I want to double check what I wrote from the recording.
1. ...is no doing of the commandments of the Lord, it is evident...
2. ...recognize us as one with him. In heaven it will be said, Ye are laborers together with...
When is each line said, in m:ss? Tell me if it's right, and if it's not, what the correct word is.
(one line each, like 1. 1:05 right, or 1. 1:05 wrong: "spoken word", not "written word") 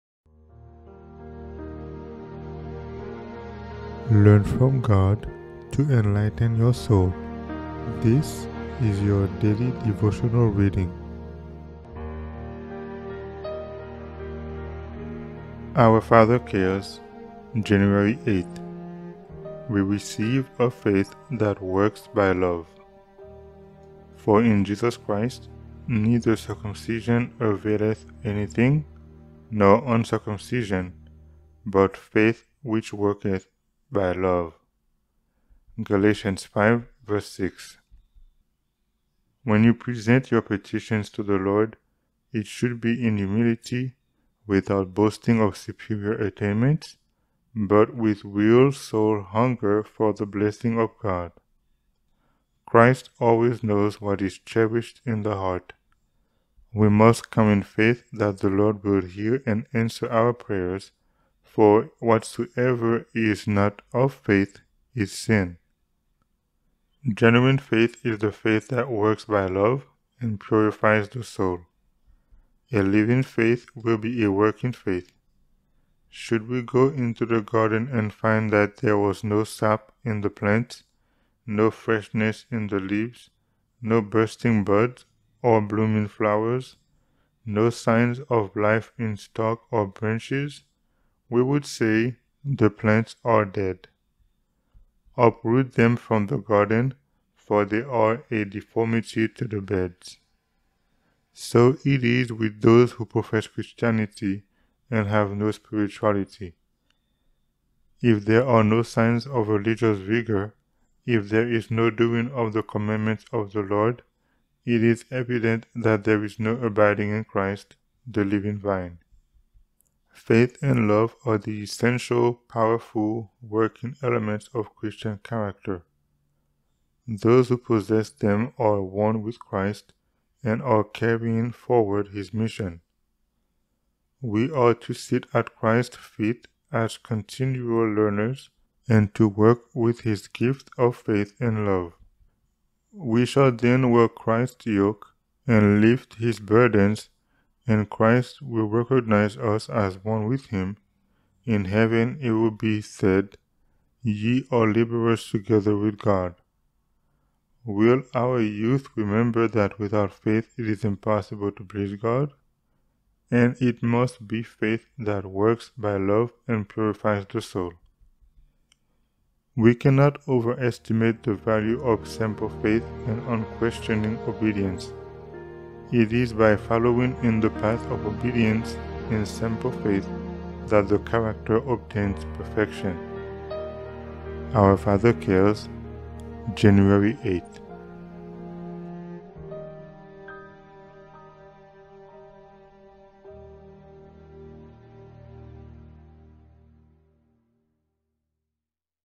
1. 1:51 right
2. 2:28 right.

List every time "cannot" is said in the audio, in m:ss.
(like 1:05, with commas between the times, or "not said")
2:49.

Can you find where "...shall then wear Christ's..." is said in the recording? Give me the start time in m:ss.
2:23.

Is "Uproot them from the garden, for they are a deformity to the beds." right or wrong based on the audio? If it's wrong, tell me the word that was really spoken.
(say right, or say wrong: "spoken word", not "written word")
right.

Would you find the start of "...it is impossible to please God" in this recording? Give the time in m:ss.
2:40.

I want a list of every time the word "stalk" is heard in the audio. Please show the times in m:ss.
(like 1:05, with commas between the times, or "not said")
1:29.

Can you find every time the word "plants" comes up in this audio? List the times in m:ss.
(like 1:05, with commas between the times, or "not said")
1:20, 1:32.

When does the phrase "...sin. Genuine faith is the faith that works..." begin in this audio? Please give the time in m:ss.
1:05.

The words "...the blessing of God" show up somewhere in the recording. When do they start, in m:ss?
0:50.